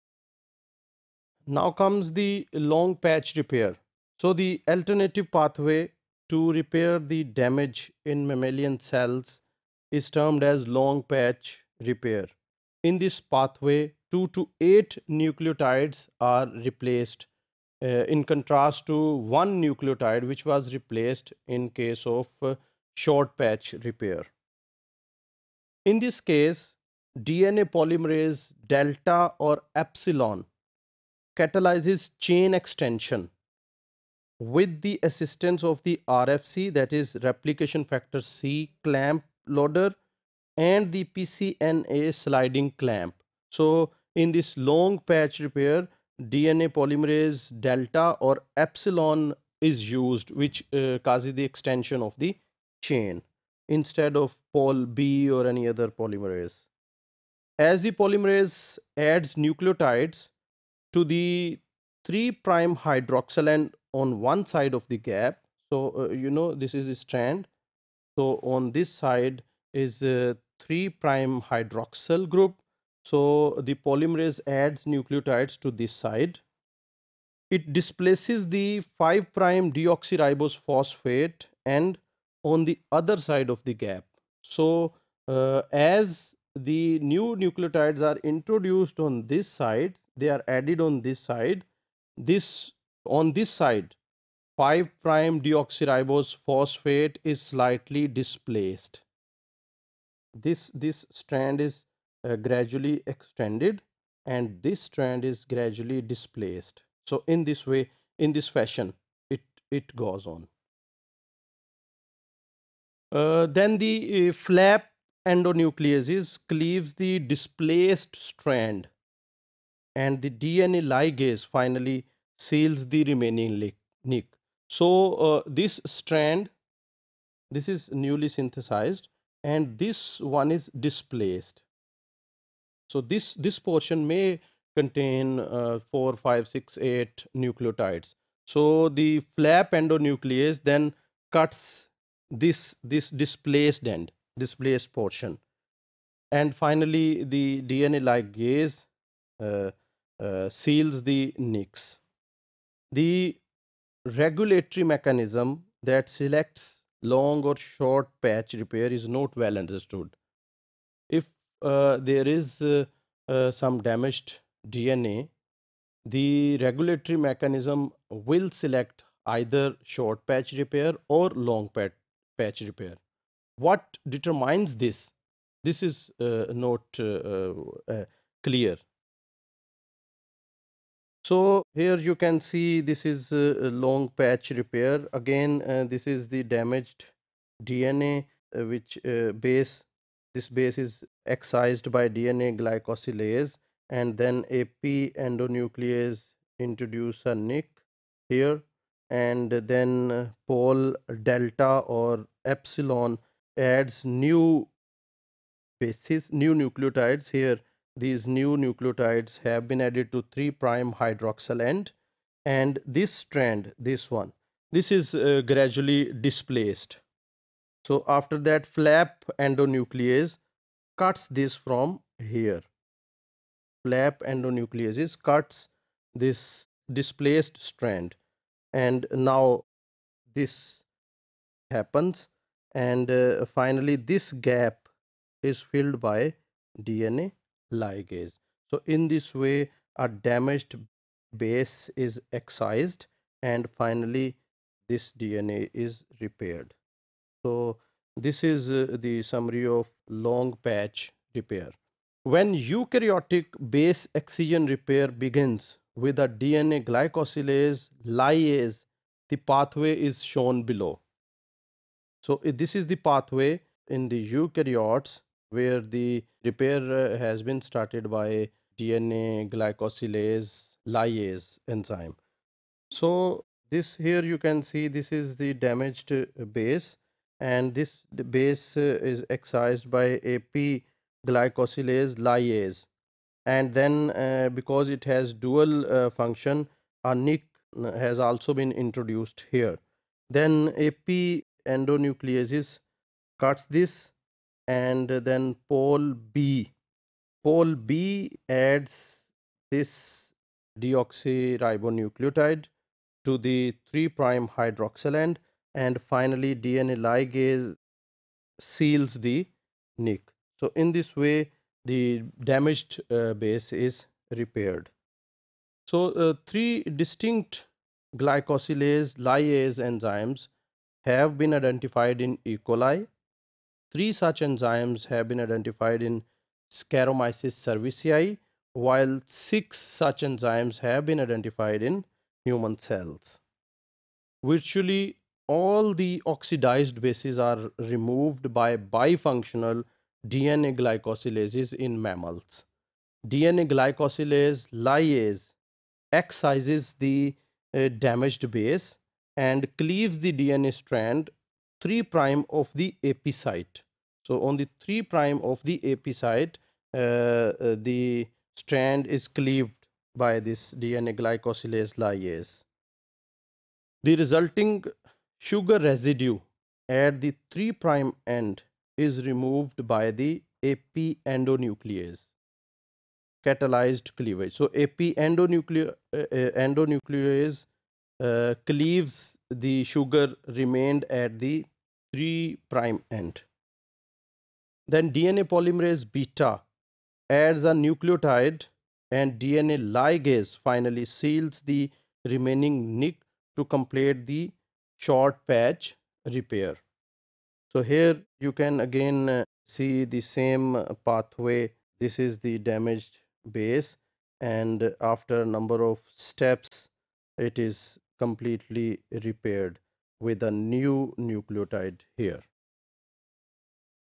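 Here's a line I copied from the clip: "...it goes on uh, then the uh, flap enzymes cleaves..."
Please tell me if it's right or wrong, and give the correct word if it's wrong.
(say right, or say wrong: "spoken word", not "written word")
wrong: "endonucleases", not "enzymes".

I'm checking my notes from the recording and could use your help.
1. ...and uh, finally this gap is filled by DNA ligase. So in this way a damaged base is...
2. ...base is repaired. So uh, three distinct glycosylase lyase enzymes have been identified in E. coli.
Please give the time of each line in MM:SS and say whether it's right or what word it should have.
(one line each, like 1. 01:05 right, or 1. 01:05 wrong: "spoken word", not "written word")
1. 03:52 right
2. 05:13 right.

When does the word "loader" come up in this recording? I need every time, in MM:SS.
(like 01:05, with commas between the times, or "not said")
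00:39.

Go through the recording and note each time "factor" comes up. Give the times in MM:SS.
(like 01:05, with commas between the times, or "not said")
00:37.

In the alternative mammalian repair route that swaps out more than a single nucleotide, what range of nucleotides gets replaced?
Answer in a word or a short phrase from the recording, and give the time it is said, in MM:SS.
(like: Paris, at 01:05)
2 to 8, at 00:14.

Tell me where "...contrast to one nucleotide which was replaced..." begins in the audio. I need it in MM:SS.
00:18.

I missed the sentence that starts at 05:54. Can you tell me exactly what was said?
So on the 3 prime of the AP site, uh, uh, the strand is cleaved by this DNA glycosylase lyase.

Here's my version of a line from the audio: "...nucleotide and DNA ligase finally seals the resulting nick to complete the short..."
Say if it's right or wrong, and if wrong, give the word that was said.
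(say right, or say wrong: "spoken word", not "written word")
wrong: "remaining", not "resulting".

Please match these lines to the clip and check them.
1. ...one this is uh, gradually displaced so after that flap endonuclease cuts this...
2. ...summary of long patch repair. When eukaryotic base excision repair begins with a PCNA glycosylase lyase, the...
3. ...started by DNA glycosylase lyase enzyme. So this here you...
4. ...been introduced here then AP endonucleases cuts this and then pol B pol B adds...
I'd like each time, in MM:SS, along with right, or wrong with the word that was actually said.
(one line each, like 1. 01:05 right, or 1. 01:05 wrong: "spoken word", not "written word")
1. 03:34 right
2. 04:09 wrong: "DNA", not "PCNA"
3. 04:27 right
4. 04:48 right.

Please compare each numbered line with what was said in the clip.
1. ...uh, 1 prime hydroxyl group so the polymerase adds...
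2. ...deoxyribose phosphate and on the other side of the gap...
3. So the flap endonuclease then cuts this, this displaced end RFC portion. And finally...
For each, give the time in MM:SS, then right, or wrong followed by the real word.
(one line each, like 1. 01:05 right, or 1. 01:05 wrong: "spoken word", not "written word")
1. 01:10 wrong: "3", not "1"
2. 01:19 right
3. 02:18 wrong: "Displaced", not "RFC".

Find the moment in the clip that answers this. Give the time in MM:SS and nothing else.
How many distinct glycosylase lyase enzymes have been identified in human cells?
05:29.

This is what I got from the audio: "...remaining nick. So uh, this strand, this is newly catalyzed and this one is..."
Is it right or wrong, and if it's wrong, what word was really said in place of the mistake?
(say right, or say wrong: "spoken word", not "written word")
wrong: "synthesized", not "catalyzed".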